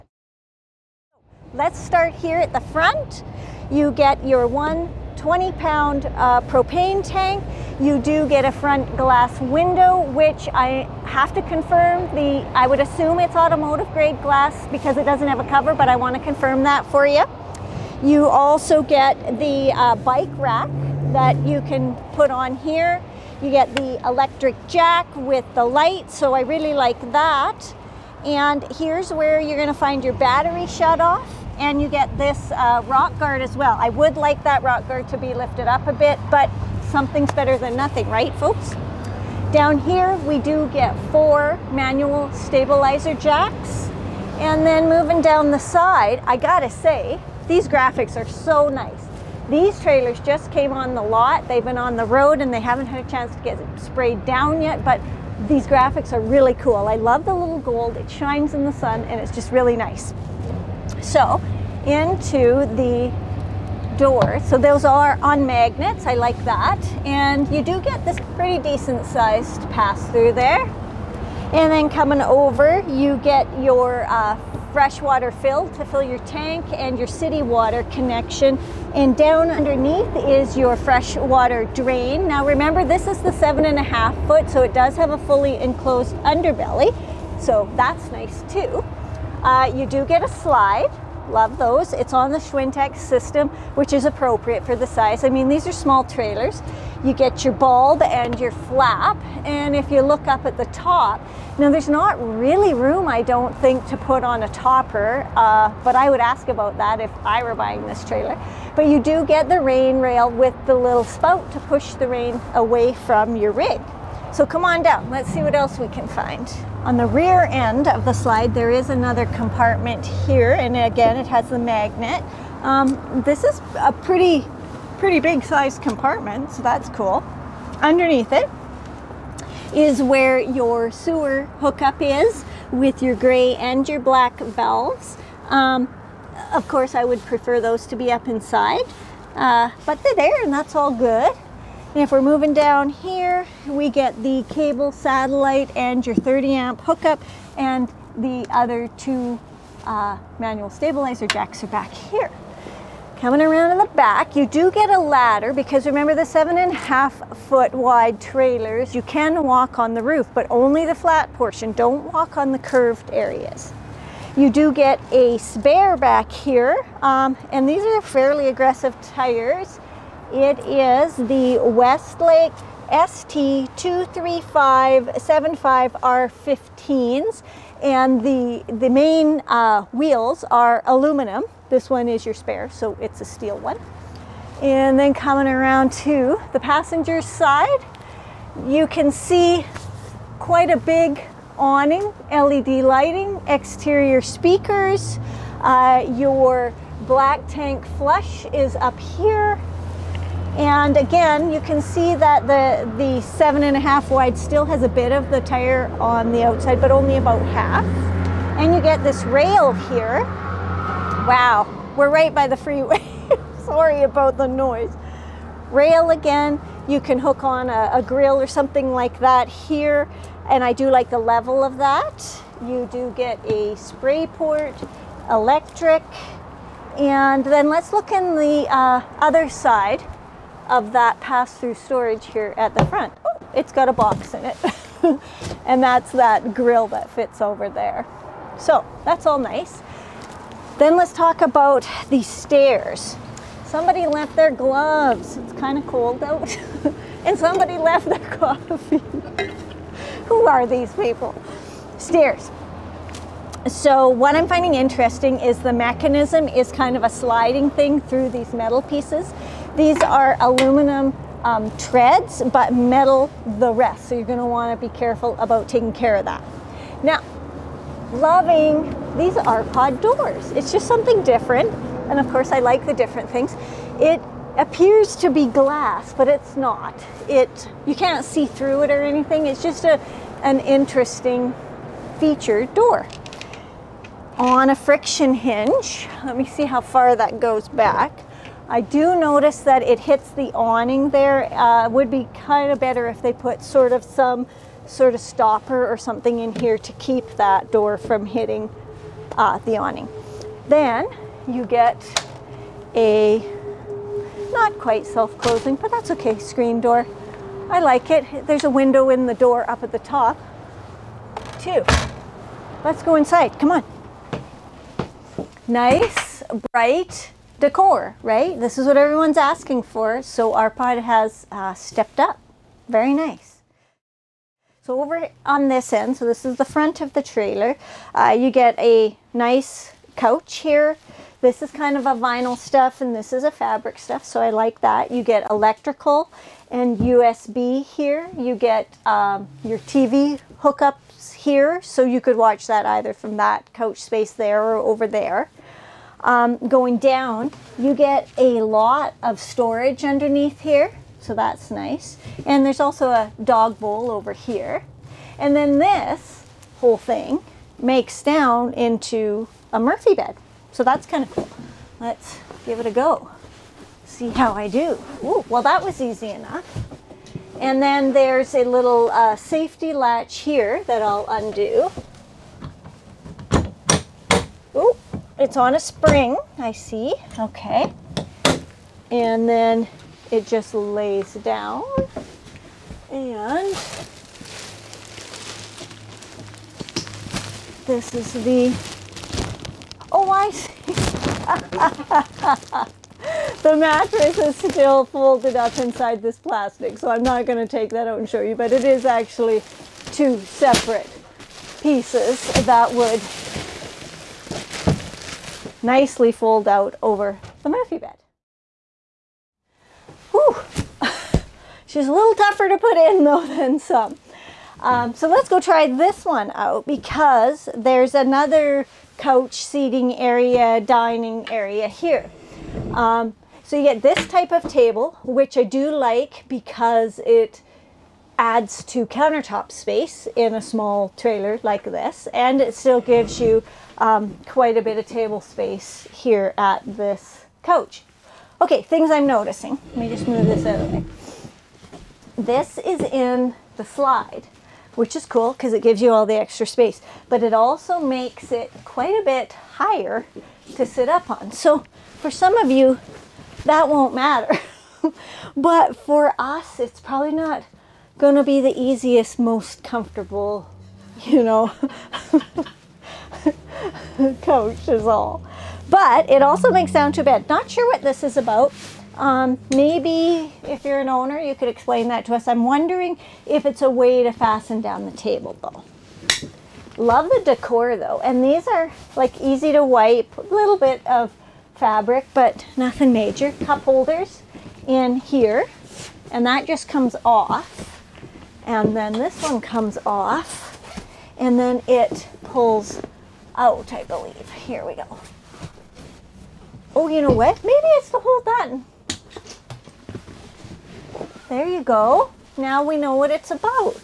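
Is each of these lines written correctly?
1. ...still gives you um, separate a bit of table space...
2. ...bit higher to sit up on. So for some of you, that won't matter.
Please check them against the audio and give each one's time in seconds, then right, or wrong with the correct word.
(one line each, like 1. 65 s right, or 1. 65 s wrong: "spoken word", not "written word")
1. 432 s wrong: "quite", not "separate"
2. 449 s right.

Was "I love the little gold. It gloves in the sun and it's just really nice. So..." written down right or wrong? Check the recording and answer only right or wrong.
wrong.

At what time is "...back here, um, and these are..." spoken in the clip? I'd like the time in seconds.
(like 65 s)
165 s.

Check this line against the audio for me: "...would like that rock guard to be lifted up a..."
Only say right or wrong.
right.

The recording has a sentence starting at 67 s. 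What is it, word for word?
And you do get this pretty decent sized pass through there.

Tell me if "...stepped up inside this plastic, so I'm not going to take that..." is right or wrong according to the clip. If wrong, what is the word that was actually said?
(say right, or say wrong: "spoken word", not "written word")
wrong: "folded", not "stepped".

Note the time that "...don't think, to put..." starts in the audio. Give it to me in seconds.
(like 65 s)
103 s.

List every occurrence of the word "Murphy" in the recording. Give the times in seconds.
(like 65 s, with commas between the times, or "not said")
359 s, 407 s.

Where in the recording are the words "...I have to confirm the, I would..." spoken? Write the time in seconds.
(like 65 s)
10 s.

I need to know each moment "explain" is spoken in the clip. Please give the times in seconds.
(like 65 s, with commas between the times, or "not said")
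471 s.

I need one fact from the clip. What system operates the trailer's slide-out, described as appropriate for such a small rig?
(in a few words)
Schwintek.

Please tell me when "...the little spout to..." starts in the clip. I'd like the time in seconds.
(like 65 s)
110 s.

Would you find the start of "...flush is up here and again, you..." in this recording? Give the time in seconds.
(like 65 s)
197 s.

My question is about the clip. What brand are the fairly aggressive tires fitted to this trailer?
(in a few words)
Westlake.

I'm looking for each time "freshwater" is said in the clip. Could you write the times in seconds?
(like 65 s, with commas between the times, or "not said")
74 s, 80 s.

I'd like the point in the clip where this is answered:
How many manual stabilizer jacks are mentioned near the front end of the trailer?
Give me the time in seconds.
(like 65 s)
41 s.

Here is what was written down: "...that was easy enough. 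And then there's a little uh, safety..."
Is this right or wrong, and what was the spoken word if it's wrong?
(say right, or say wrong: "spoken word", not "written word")
right.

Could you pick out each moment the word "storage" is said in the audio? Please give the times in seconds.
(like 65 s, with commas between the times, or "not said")
231 s, 349 s.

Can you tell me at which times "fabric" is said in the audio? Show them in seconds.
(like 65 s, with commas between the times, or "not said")
333 s, 481 s.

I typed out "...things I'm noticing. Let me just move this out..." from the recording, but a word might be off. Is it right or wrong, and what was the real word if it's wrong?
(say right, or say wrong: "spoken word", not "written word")
right.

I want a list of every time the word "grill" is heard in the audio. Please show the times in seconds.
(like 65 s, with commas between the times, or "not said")
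218 s, 236 s.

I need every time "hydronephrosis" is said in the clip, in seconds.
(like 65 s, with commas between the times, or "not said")
not said.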